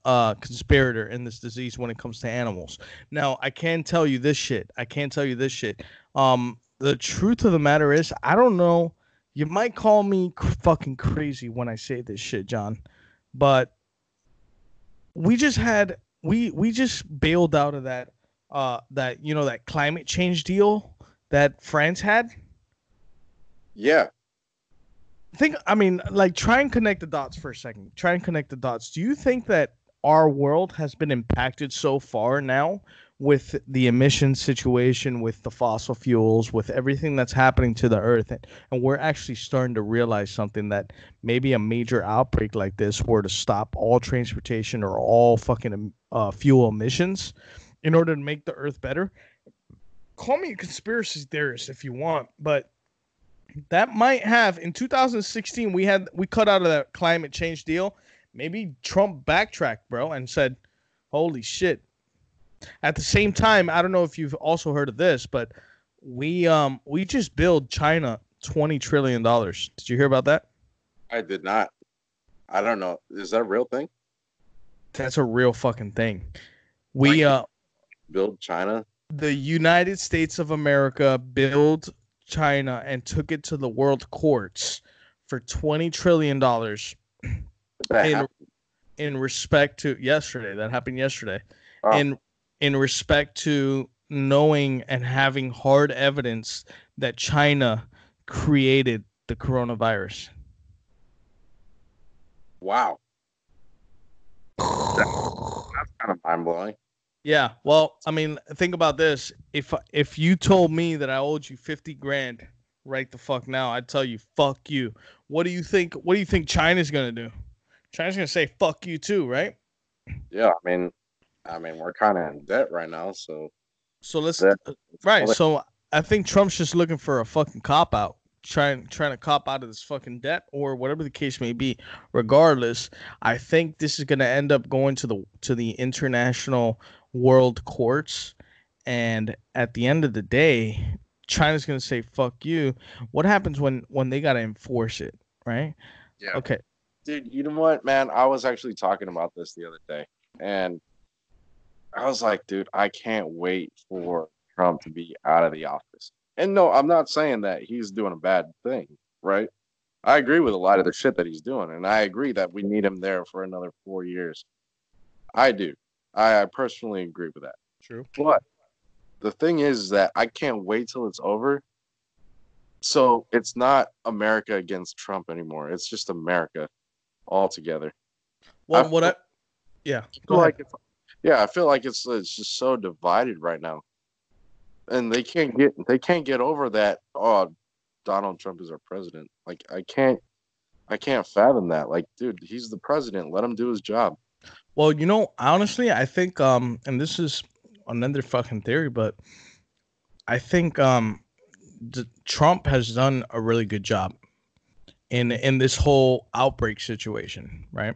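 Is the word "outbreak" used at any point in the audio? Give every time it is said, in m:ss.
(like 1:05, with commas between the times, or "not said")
0:42, 3:26.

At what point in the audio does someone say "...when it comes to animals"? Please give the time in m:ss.
0:01.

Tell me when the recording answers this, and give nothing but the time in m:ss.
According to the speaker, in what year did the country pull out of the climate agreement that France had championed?
0:54.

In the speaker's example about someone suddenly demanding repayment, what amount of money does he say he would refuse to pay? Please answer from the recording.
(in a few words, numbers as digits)
$50,000.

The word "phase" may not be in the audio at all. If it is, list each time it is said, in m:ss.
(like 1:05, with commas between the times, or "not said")
not said.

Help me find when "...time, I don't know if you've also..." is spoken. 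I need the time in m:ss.
1:03.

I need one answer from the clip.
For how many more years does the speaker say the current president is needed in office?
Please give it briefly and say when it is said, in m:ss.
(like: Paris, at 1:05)
4, at 2:43.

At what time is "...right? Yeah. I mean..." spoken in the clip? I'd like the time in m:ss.
1:59.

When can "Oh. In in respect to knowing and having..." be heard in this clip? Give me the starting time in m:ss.
1:31.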